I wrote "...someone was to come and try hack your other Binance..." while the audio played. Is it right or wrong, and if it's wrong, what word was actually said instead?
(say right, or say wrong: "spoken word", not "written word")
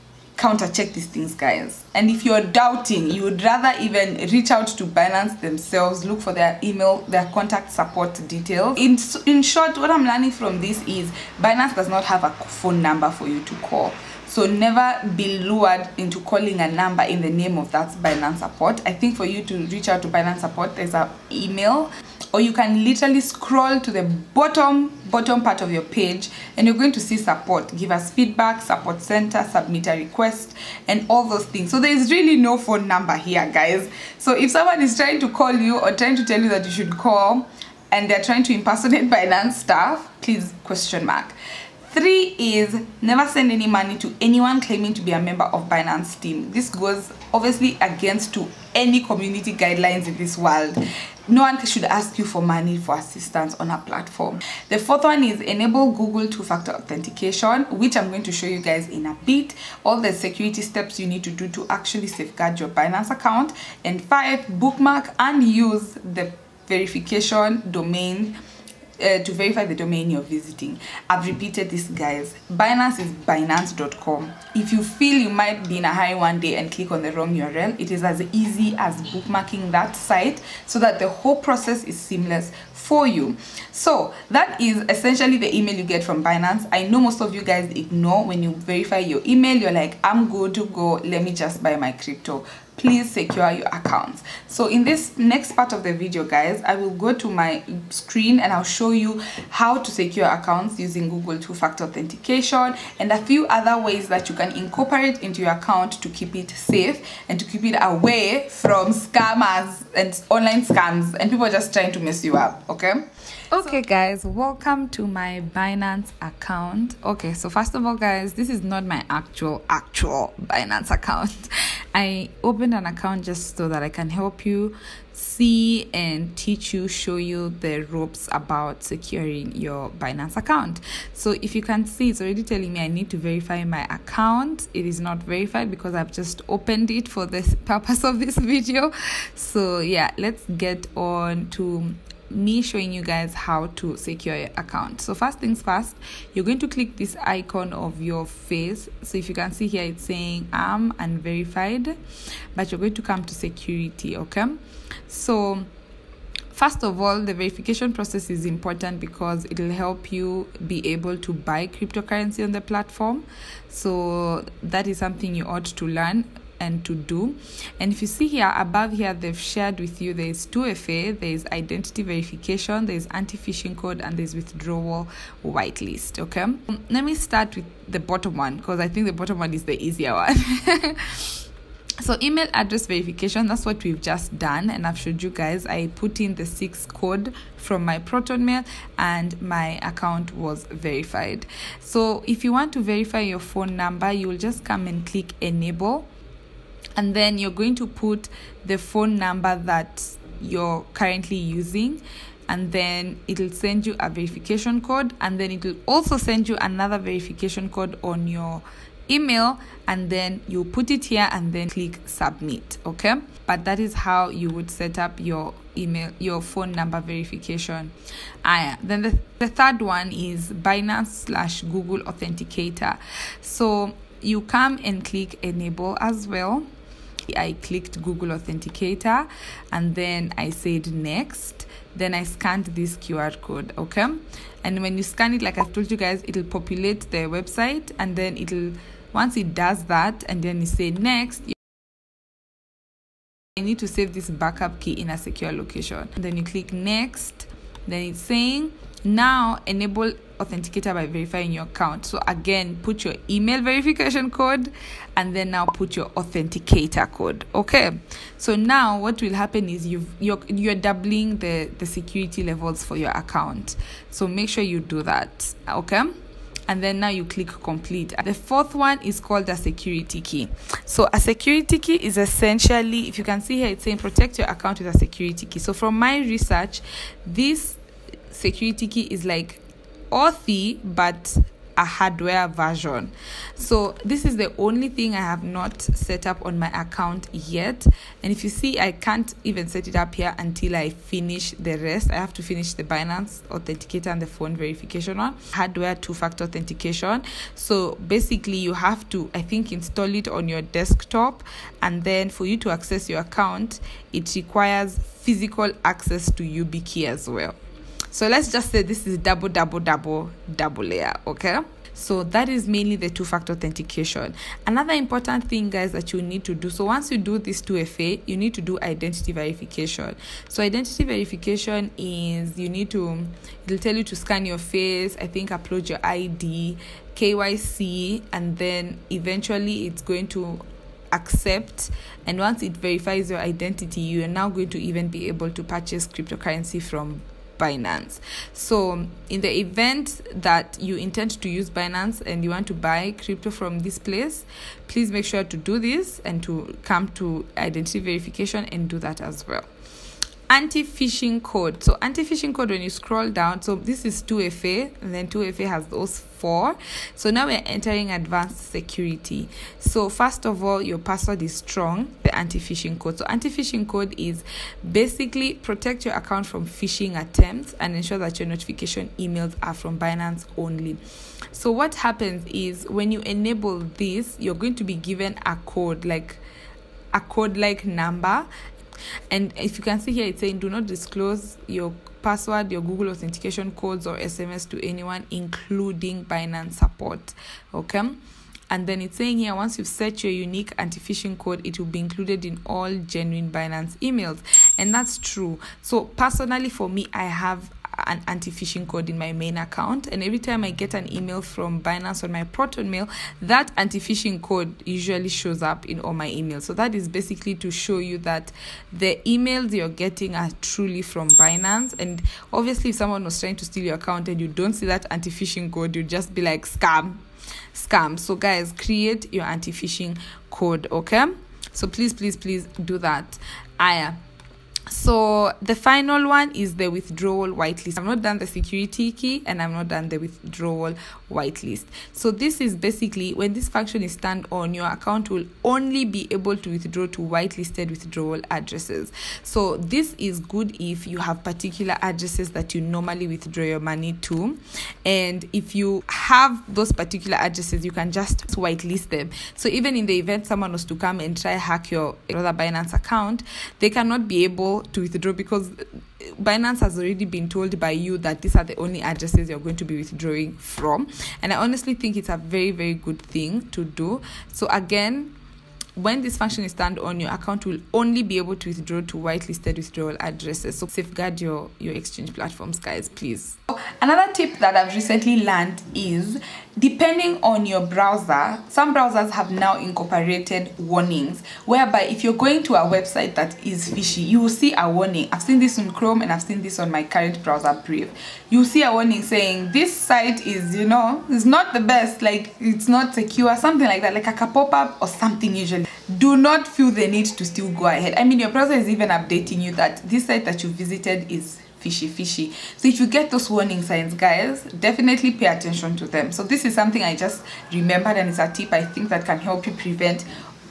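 right.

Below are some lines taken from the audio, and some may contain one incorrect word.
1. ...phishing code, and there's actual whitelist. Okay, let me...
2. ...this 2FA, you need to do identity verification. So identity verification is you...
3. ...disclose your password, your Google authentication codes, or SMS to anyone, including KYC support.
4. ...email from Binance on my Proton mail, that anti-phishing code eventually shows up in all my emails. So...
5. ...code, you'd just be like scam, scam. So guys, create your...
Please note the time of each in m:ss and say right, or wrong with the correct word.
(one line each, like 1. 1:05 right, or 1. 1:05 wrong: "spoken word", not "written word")
1. 2:53 wrong: "withdrawal", not "actual"
2. 5:17 right
3. 6:20 wrong: "Binance", not "KYC"
4. 6:41 wrong: "usually", not "eventually"
5. 6:55 right.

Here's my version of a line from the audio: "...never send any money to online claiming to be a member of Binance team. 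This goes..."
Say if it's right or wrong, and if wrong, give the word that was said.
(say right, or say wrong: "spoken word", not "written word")
wrong: "anyone", not "online".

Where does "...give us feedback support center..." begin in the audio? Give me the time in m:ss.
0:27.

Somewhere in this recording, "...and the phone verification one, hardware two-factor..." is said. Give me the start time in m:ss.
4:54.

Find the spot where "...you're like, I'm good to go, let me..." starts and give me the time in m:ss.
1:29.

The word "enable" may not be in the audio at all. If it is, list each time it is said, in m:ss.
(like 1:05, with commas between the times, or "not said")
0:55, 3:15, 3:45, 4:09, 6:13.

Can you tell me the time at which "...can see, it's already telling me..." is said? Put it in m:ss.
2:11.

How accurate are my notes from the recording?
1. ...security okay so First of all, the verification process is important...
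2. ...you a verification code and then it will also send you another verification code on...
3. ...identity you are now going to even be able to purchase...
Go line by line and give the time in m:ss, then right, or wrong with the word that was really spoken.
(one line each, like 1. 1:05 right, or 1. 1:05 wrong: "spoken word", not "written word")
1. 2:33 right
2. 3:23 right
3. 5:33 right.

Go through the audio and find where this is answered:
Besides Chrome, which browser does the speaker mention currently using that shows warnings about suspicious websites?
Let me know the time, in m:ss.
8:07.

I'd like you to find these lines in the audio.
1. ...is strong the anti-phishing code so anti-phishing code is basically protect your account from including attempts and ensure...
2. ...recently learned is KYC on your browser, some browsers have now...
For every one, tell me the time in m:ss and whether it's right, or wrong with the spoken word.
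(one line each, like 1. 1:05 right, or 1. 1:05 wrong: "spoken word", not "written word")
1. 6:01 wrong: "phishing", not "including"
2. 7:54 wrong: "Depending", not "KYC".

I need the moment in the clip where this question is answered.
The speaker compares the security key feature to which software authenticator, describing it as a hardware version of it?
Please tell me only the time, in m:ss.
4:40.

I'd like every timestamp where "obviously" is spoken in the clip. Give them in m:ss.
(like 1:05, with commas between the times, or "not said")
0:47, 6:52.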